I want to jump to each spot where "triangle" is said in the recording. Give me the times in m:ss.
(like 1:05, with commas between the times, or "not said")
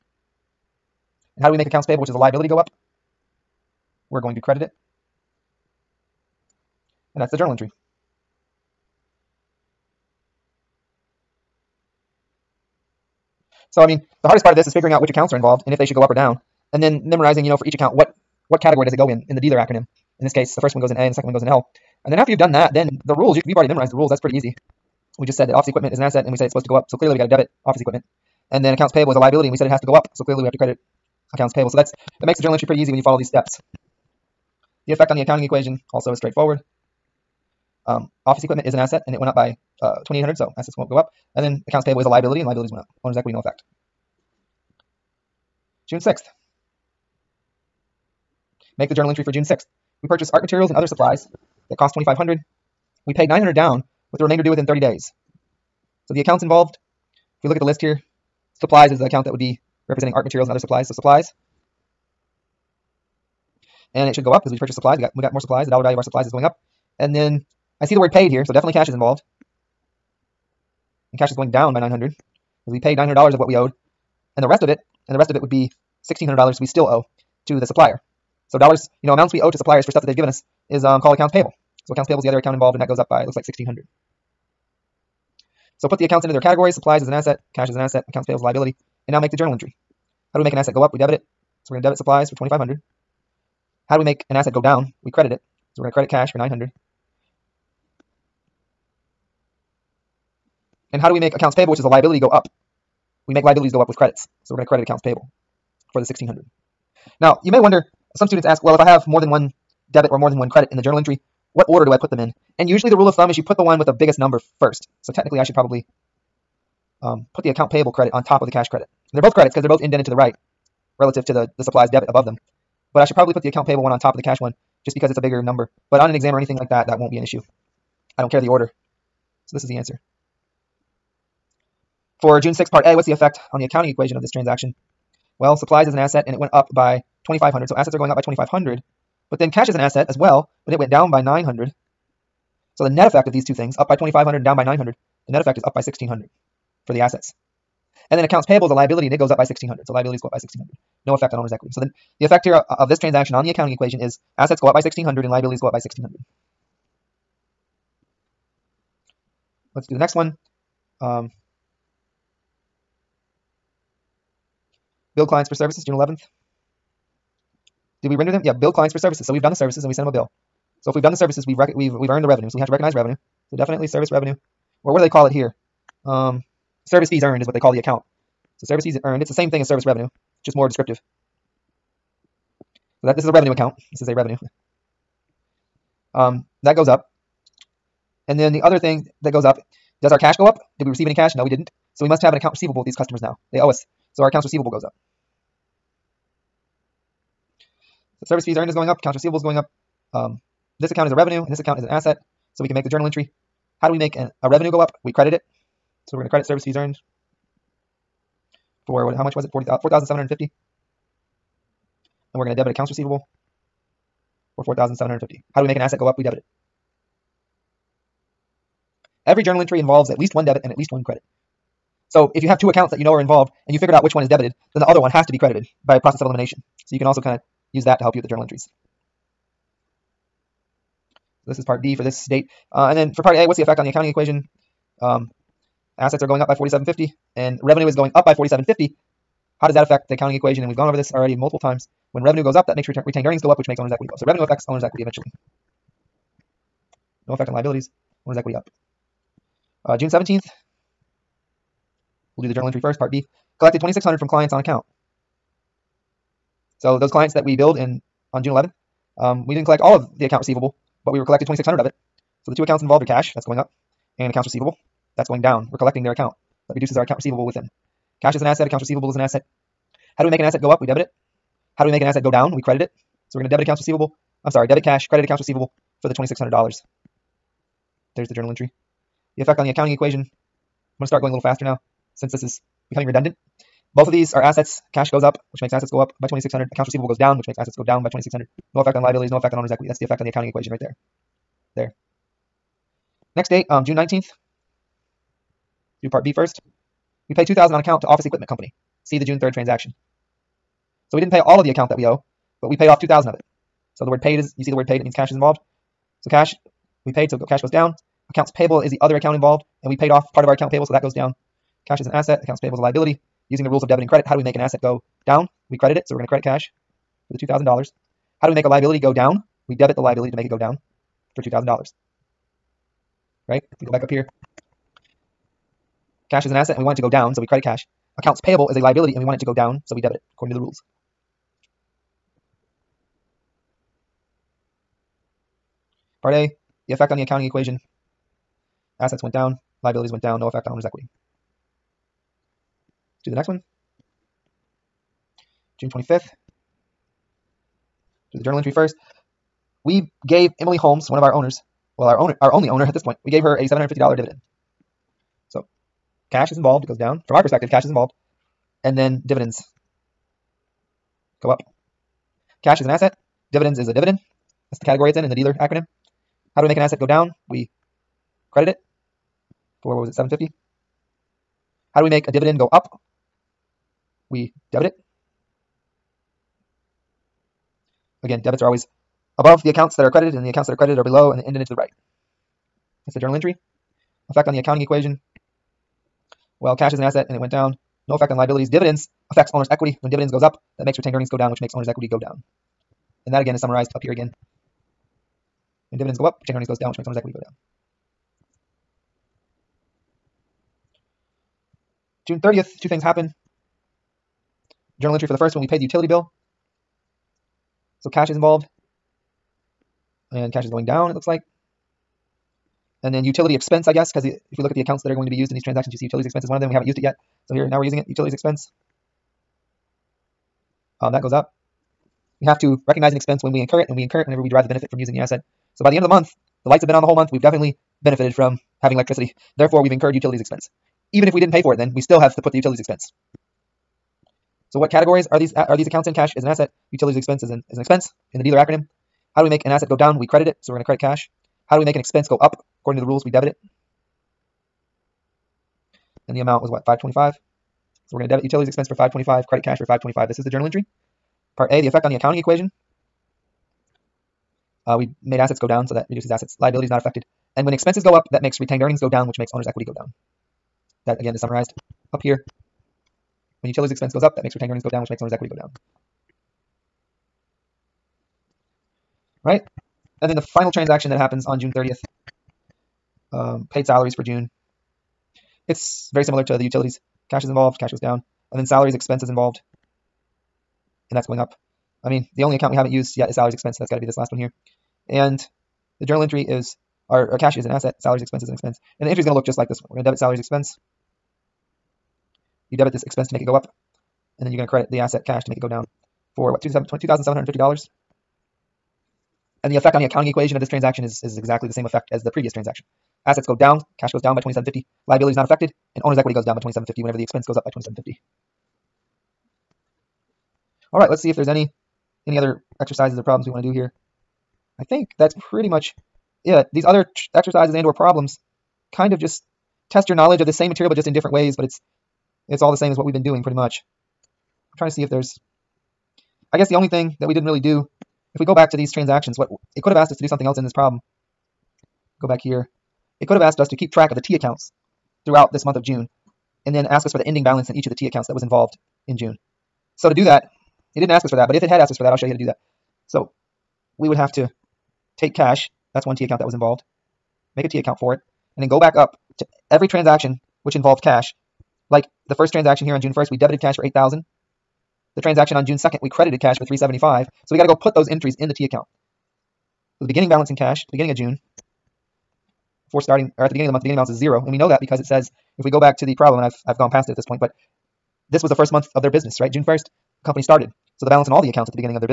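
not said.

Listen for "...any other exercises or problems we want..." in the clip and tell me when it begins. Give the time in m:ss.
8:32.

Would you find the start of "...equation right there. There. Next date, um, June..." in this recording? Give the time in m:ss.
4:50.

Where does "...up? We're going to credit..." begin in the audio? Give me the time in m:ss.
0:02.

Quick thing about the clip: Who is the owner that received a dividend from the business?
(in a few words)
Emily Holmes.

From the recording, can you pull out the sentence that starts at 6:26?
Well, cash is an asset and it went down.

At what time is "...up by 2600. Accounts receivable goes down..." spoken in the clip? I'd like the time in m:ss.
4:45.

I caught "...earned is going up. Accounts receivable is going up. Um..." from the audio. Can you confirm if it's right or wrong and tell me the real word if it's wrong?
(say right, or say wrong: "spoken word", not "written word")
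right.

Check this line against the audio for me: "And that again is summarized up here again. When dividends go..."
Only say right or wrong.
right.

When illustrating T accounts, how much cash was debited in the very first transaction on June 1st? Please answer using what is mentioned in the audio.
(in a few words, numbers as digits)
8000.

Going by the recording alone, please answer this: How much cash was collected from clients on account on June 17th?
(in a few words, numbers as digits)
2600.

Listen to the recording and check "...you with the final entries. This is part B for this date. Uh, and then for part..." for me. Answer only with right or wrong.
wrong.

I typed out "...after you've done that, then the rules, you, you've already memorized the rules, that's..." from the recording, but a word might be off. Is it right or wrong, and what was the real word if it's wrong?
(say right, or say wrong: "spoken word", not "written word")
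right.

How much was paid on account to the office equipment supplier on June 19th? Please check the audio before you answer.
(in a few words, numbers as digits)
2000.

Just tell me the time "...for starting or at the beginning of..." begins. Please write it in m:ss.
9:22.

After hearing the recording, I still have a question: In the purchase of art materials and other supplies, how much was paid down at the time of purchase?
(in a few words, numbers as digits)
900.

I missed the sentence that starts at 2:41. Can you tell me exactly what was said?
Um, billed clients for services, June 11th.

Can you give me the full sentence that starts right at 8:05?
And the journal entry is our, our cash is an asset, salaries, expenses, and expense.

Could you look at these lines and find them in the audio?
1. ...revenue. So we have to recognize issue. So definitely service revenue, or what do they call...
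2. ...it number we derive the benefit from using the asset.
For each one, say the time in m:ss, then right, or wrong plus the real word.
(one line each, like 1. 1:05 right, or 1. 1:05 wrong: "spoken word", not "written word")
1. 2:52 wrong: "revenue", not "issue"
2. 7:04 wrong: "whenever", not "number".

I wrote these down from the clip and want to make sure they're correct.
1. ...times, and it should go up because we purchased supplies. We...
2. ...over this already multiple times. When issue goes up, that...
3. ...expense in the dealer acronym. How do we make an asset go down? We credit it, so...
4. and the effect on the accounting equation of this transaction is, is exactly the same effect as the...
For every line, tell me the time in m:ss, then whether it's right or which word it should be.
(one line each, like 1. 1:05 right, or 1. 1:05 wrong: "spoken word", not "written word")
1. 1:00 wrong: "supplies", not "times"
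2. 4:00 wrong: "revenue", not "issue"
3. 7:17 right
4. 8:19 right.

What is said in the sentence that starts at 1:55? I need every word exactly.
So technically I should probably um, put the account payable credit on top of the cash credit.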